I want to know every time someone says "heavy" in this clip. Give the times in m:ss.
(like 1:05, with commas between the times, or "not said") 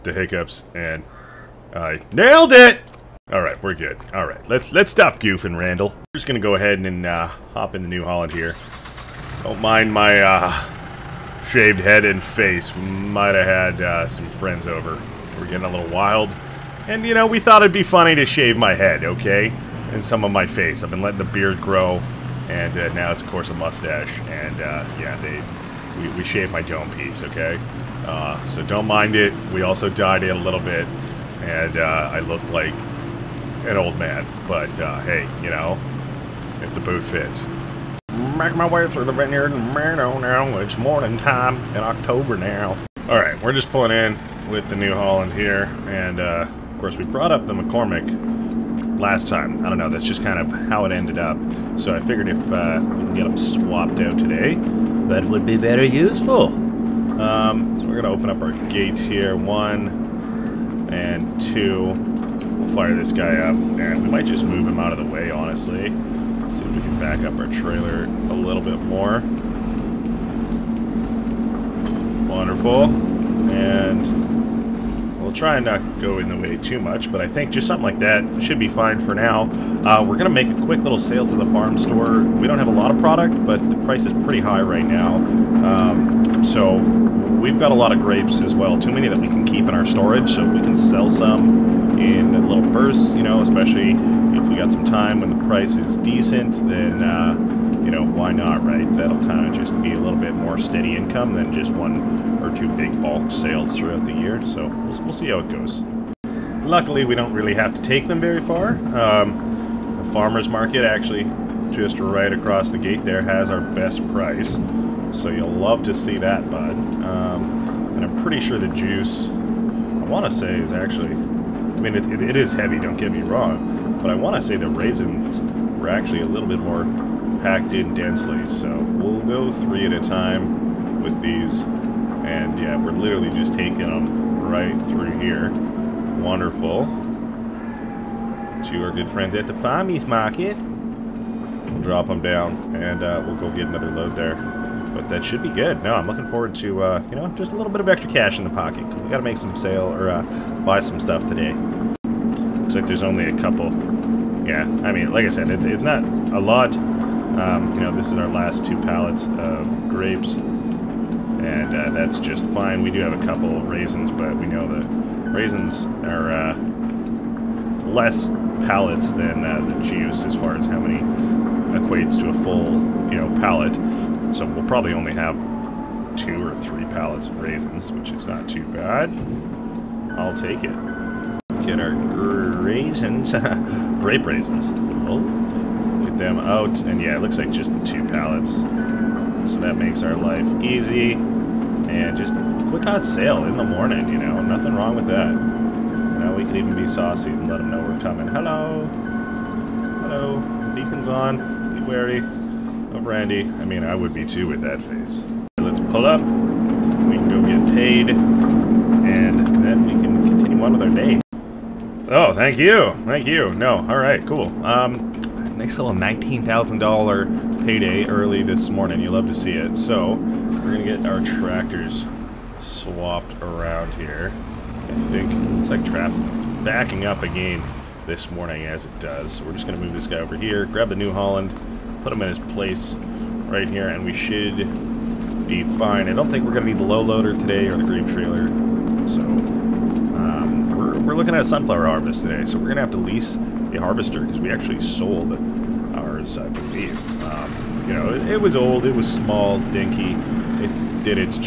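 2:02.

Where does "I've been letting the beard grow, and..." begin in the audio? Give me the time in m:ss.
0:20.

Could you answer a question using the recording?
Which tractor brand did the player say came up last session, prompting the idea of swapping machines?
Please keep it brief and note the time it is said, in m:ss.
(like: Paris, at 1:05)
McCormick, at 0:47.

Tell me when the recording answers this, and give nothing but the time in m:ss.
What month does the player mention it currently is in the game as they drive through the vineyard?
0:41.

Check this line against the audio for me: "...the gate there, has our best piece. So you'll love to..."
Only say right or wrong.
wrong.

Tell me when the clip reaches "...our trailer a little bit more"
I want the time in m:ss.
1:07.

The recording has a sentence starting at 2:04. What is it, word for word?
But I want to say the raisins were actually a little bit more packed in densely.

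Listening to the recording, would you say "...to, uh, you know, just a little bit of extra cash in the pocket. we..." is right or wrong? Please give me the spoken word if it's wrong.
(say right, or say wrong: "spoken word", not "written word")
right.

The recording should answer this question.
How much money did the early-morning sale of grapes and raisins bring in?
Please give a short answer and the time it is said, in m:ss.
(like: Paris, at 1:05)
$19,000, at 3:35.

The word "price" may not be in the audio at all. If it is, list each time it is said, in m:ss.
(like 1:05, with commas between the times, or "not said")
1:23, 1:35, 1:54.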